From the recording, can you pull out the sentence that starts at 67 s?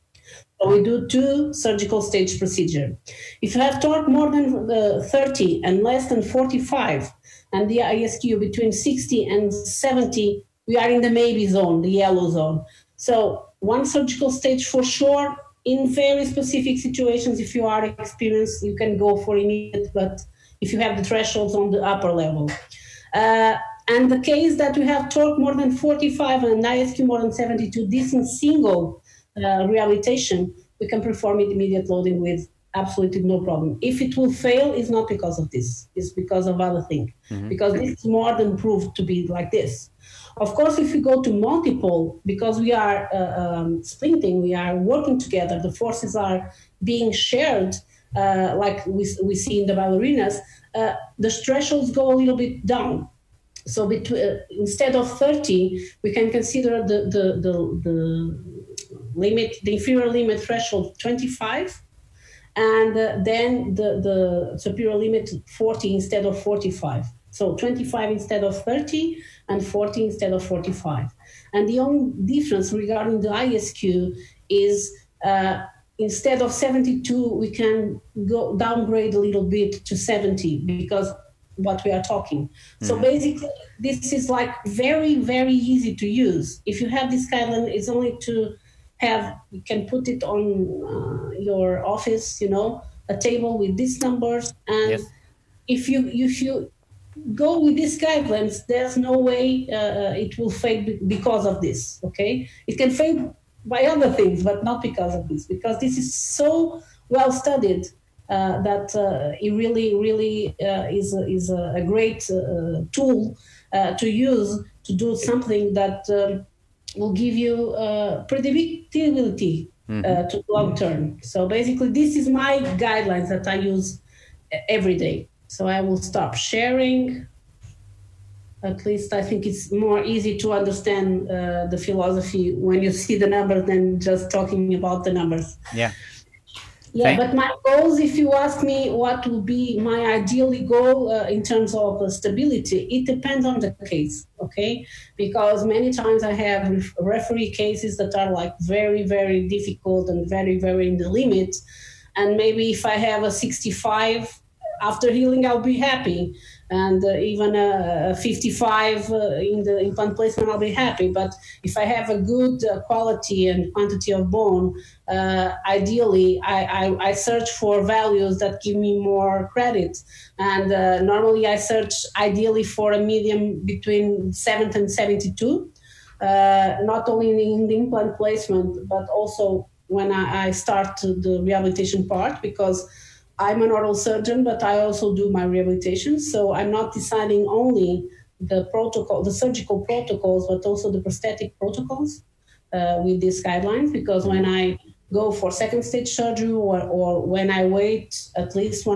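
So 25 instead of 30, and 40 instead of 45.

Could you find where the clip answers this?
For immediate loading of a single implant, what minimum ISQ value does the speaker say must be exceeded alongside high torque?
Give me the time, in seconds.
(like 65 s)
27 s.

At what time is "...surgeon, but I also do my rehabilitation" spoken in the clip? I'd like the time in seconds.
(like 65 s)
183 s.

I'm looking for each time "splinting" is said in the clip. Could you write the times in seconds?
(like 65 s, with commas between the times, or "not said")
43 s.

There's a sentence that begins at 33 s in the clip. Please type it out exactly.
If it will fail, it's not because of this, it's because of other things.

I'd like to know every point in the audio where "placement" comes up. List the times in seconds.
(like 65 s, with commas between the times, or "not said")
160 s, 178 s.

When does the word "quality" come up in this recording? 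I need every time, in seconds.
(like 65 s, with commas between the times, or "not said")
162 s.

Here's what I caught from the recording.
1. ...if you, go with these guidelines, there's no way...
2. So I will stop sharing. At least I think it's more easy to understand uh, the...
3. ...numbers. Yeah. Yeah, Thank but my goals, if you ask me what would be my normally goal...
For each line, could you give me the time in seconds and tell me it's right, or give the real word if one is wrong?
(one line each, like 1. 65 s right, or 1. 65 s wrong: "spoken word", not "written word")
1. 96 s right
2. 125 s right
3. 135 s wrong: "ideally", not "normally".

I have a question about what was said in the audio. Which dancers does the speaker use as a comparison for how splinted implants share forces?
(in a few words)
ballerinas.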